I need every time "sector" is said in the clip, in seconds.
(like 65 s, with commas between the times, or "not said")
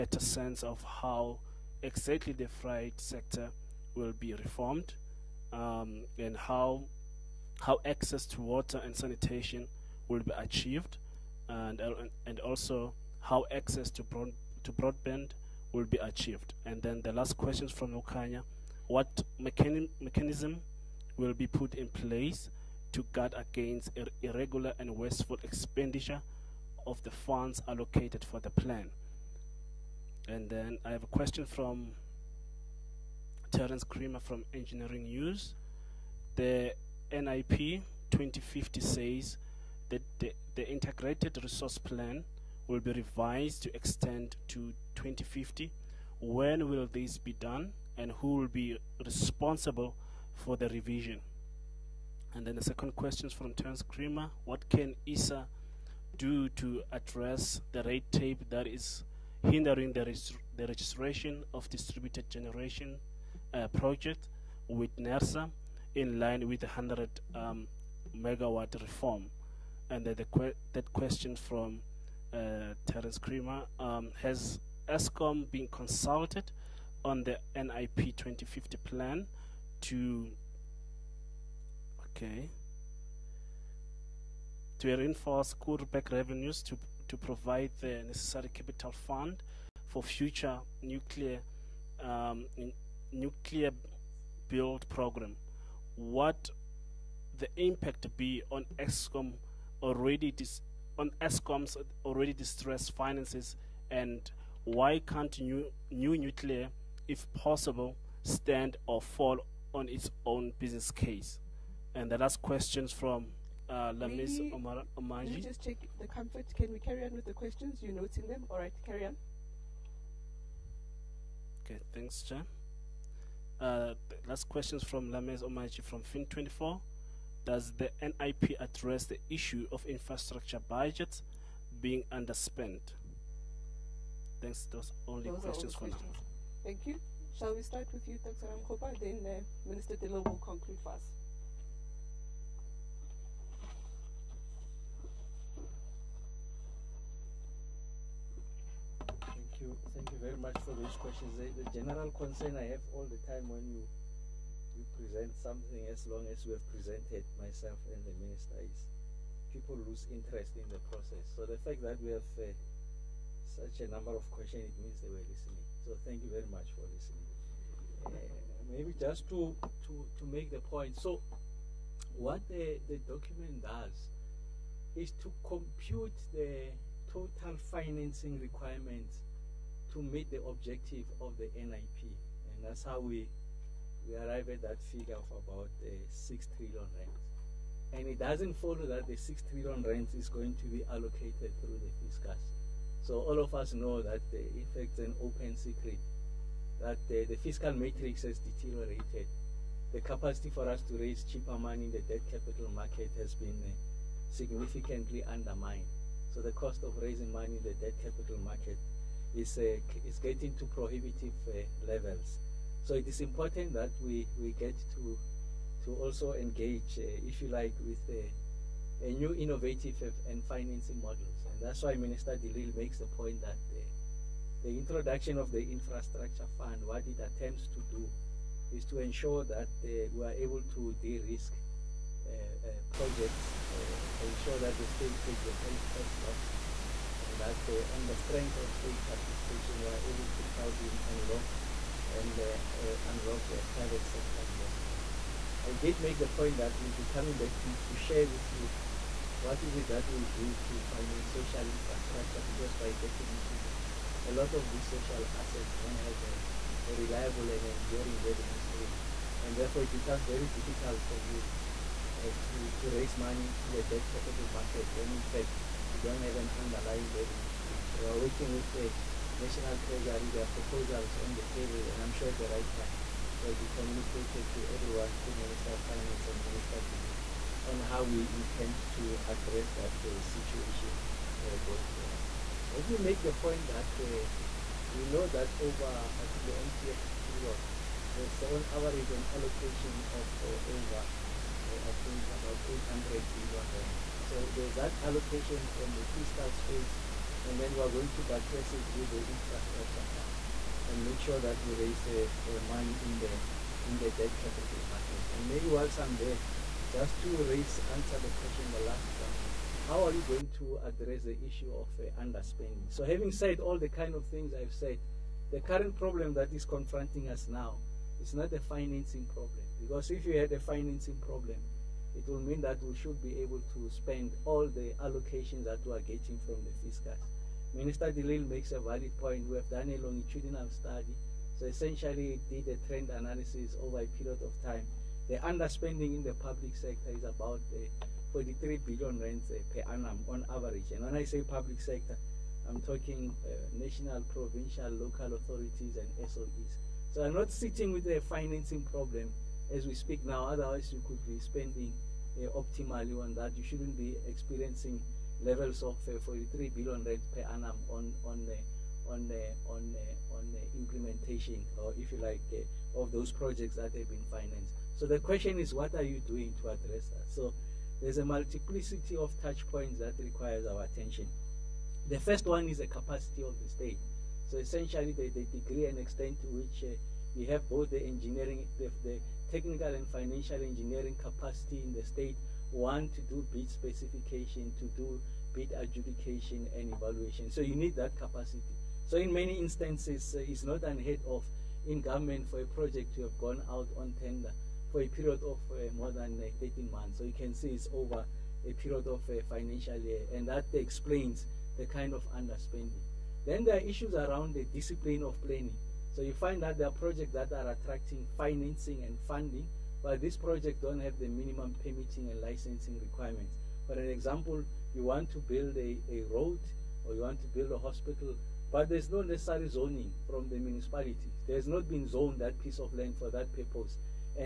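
2 s, 244 s, 336 s, 341 s.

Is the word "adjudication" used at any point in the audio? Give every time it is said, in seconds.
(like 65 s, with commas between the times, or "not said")
385 s.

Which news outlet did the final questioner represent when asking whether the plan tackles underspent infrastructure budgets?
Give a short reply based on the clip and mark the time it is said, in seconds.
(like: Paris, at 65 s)
Fin24, at 126 s.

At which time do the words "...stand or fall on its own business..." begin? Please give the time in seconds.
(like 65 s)
108 s.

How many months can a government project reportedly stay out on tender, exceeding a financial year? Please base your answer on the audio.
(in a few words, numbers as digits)
13 months.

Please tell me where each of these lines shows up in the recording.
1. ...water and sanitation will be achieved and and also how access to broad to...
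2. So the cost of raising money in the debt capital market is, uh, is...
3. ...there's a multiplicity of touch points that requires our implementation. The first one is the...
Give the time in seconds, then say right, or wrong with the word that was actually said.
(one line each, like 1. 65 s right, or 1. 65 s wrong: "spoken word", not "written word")
1. 8 s right
2. 206 s right
3. 368 s wrong: "attention", not "implementation".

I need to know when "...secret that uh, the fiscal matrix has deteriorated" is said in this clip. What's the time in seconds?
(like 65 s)
195 s.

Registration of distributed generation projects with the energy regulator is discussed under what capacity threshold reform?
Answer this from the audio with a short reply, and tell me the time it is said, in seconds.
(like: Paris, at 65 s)
100 megawatt, at 66 s.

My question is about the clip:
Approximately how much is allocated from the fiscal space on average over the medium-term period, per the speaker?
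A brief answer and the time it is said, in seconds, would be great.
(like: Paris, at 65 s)
800 billion rand, at 292 s.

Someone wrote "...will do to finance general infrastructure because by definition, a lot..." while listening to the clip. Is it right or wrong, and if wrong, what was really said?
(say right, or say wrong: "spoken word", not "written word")
wrong: "social", not "general".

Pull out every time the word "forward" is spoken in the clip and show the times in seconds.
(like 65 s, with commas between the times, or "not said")
281 s.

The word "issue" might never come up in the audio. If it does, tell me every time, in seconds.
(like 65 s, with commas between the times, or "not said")
129 s, 311 s, 403 s.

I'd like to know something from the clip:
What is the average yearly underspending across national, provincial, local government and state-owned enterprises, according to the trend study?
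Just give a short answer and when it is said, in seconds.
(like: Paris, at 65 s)
43 billion rand, at 338 s.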